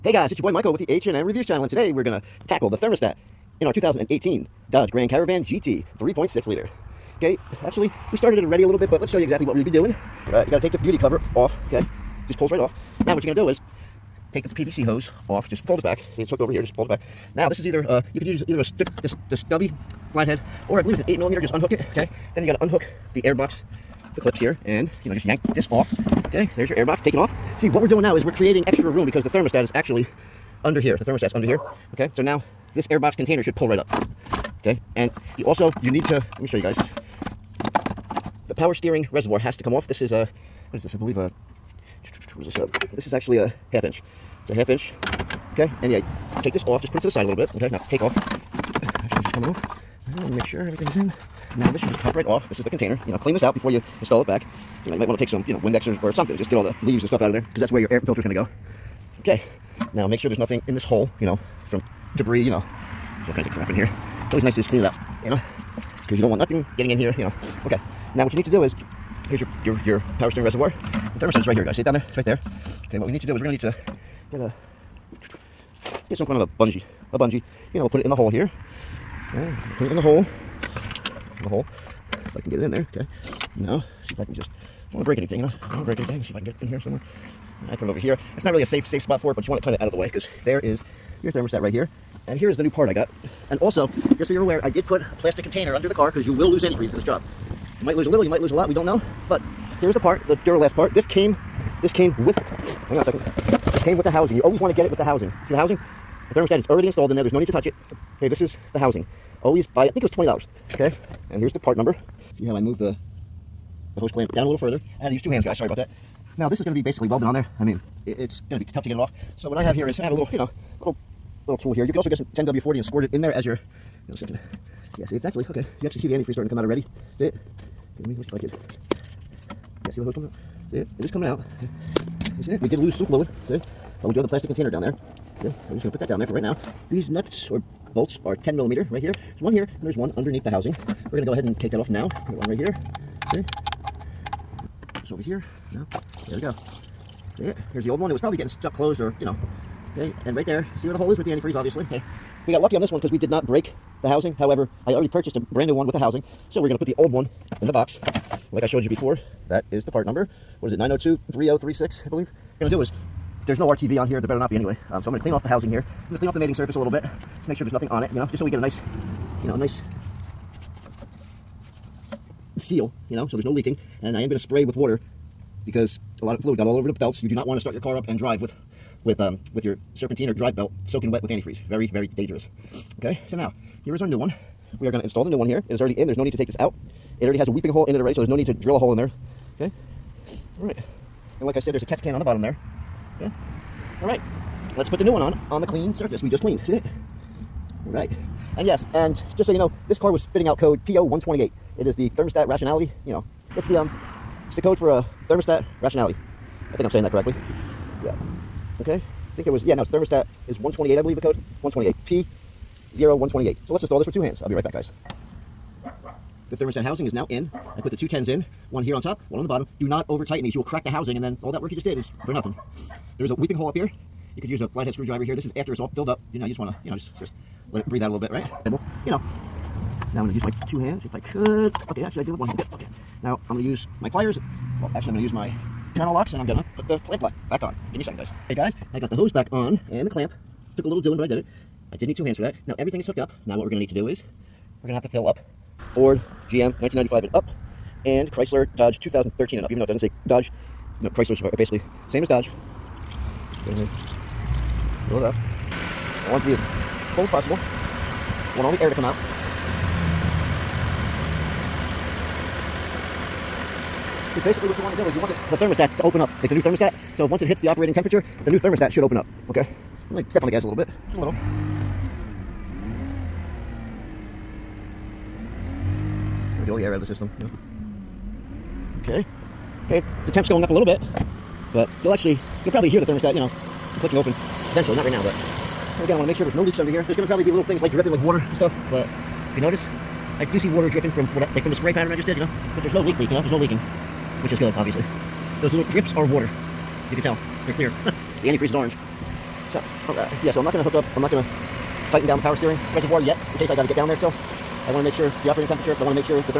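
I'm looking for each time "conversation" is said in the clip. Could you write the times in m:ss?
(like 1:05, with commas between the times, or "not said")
not said.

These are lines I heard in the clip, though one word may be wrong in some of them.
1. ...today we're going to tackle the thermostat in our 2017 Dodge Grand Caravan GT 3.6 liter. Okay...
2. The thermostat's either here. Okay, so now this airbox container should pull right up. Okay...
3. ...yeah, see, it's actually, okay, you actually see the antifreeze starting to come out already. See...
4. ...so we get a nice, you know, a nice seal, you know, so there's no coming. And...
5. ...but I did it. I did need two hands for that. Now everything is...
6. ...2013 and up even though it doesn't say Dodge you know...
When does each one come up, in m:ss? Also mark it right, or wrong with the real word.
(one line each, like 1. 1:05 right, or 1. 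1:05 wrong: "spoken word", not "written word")
1. 0:01 wrong: "2018", not "2017"
2. 0:30 wrong: "under", not "either"
3. 2:04 right
4. 2:48 wrong: "leaking", not "coming"
5. 4:01 right
6. 4:09 right.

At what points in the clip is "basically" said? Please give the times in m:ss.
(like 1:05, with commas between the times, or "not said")
1:56, 4:11, 4:24.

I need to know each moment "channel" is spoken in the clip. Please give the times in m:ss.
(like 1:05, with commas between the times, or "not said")
0:01, 3:55.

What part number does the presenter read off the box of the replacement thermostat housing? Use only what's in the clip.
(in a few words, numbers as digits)
902-3036.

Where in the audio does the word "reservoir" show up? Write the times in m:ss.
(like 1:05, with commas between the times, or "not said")
0:39, 1:10, 5:02.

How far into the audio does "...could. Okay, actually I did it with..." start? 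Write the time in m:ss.
3:51.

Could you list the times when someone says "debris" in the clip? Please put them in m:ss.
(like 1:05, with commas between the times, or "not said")
1:02.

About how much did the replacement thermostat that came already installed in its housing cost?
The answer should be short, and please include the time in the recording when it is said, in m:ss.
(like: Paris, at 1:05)
$20, at 1:50.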